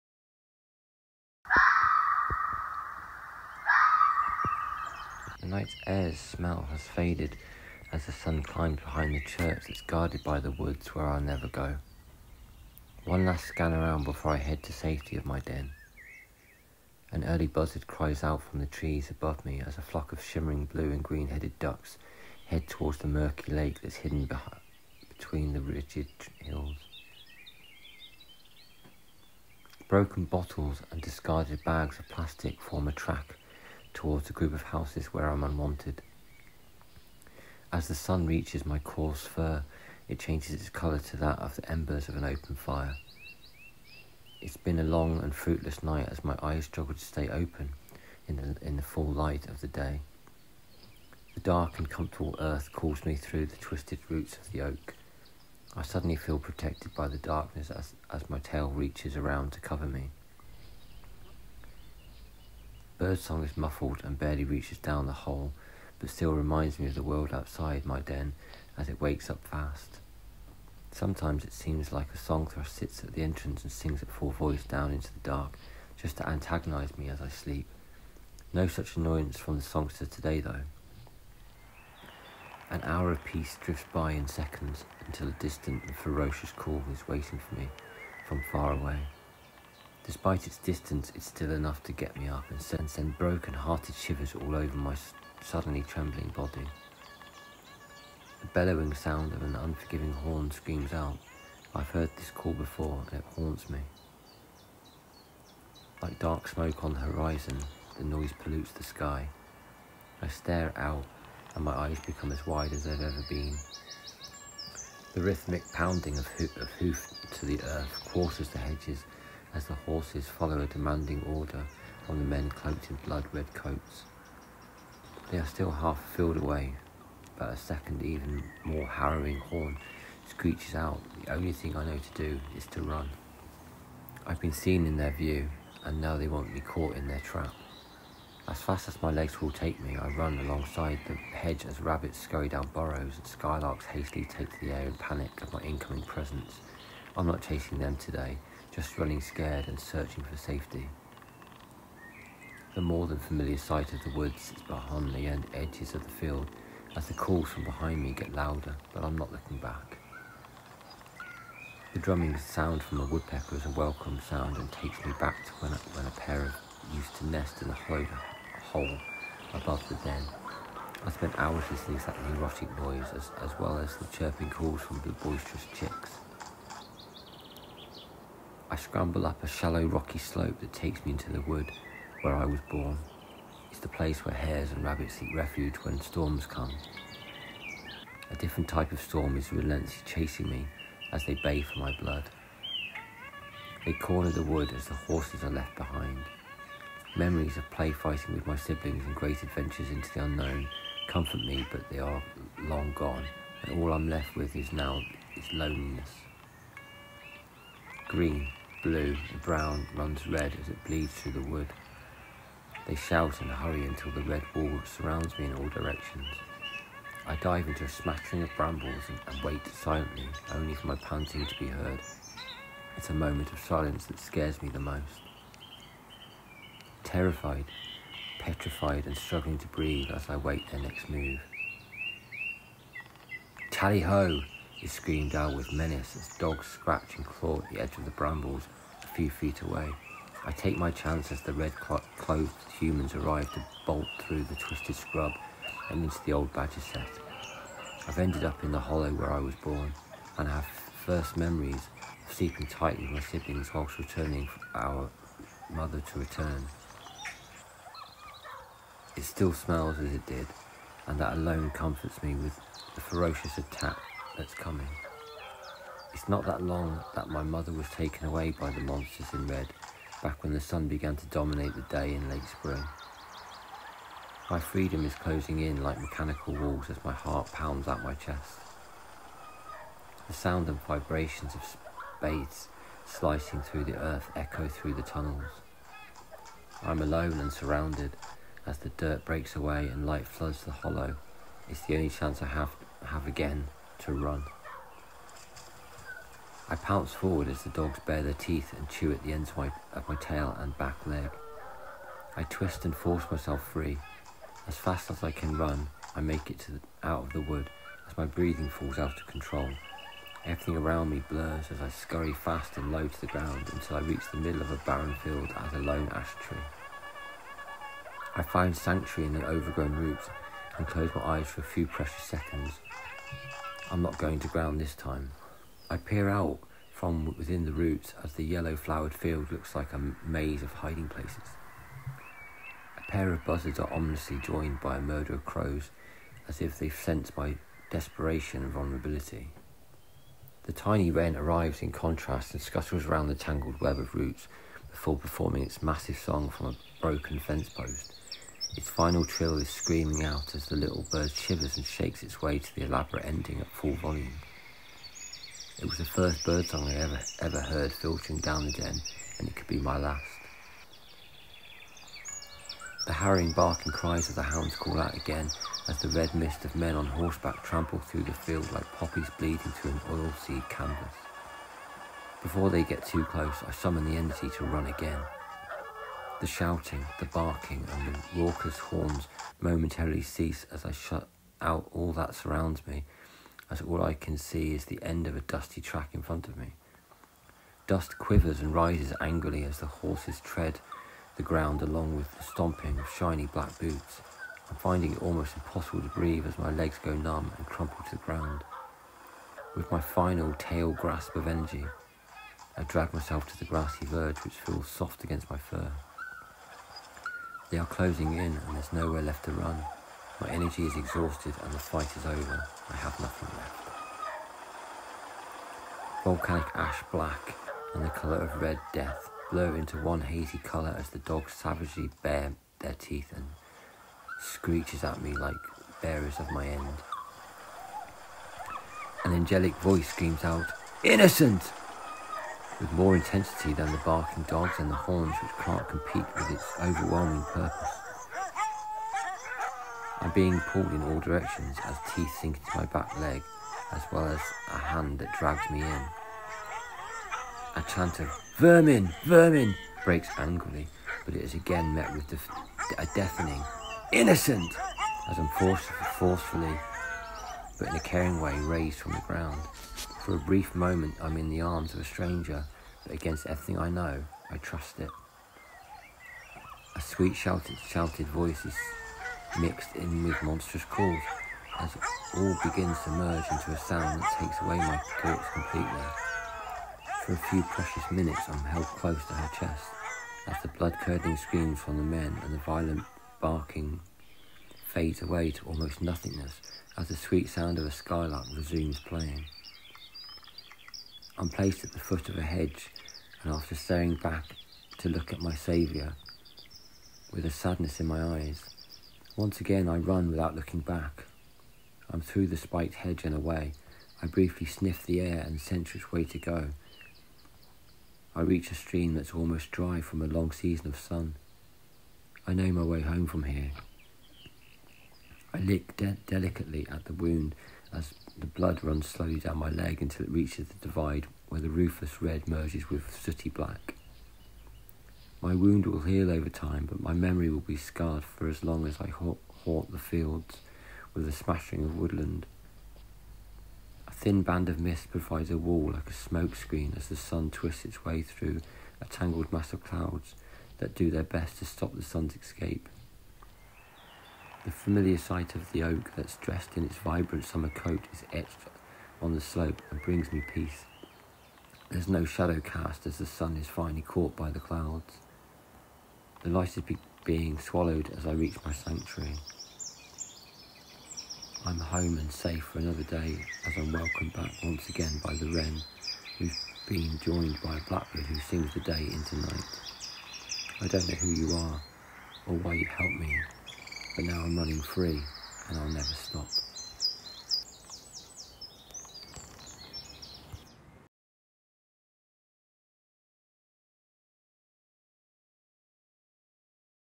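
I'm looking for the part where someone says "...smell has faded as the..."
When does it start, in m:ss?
0:06.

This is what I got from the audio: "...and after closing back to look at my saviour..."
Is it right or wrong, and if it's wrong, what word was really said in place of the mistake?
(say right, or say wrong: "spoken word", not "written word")
wrong: "staring", not "closing".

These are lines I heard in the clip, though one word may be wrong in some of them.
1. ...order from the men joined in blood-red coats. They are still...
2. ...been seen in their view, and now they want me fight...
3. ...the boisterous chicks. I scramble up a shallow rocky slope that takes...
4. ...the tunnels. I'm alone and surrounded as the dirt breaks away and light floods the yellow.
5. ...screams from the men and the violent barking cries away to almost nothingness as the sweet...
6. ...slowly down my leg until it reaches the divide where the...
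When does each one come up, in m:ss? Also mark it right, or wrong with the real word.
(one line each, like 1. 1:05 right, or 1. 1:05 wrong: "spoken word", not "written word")
1. 2:01 wrong: "cloaked", not "joined"
2. 2:14 wrong: "caught", not "fight"
3. 2:55 right
4. 4:44 wrong: "hollow", not "yellow"
5. 8:01 wrong: "fades", not "cries"
6. 8:39 right.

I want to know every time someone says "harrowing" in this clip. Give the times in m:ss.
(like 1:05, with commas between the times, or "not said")
2:08, 6:03.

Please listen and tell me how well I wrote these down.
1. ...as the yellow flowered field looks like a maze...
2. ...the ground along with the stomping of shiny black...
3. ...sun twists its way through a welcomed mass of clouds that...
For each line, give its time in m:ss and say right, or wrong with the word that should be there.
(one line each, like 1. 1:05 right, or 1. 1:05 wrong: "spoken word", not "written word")
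1. 5:28 right
2. 6:31 right
3. 8:57 wrong: "tangled", not "welcomed".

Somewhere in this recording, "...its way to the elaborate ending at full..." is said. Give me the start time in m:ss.
5:52.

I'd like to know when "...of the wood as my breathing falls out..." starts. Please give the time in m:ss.
5:07.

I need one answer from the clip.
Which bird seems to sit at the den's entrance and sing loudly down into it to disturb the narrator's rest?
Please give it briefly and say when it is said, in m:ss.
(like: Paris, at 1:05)
Song thrush, at 1:12.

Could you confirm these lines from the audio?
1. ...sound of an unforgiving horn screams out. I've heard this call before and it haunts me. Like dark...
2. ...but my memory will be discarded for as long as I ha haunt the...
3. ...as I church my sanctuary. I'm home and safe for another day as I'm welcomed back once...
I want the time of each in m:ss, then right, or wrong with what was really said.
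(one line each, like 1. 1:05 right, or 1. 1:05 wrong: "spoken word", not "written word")
1. 1:38 right
2. 8:46 wrong: "scarred", not "discarded"
3. 9:18 wrong: "reach", not "church".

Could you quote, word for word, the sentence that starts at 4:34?
My freedom is closing in like mechanical walls as my heart pounds out my chest.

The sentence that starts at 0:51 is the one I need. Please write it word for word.
The dark and comfortable earth calls me through the twisted roots of the oak.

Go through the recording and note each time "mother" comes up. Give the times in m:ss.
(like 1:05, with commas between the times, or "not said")
4:15, 4:27.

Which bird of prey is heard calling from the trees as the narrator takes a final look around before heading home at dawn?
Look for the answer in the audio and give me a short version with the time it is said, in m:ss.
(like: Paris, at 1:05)
Buzzard, at 0:17.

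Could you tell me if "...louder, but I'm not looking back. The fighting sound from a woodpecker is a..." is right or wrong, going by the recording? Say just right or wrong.
wrong.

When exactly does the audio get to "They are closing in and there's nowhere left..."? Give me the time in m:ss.
6:47.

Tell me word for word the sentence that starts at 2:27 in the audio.
I'm not chasing them today, just running scared and searching for safety.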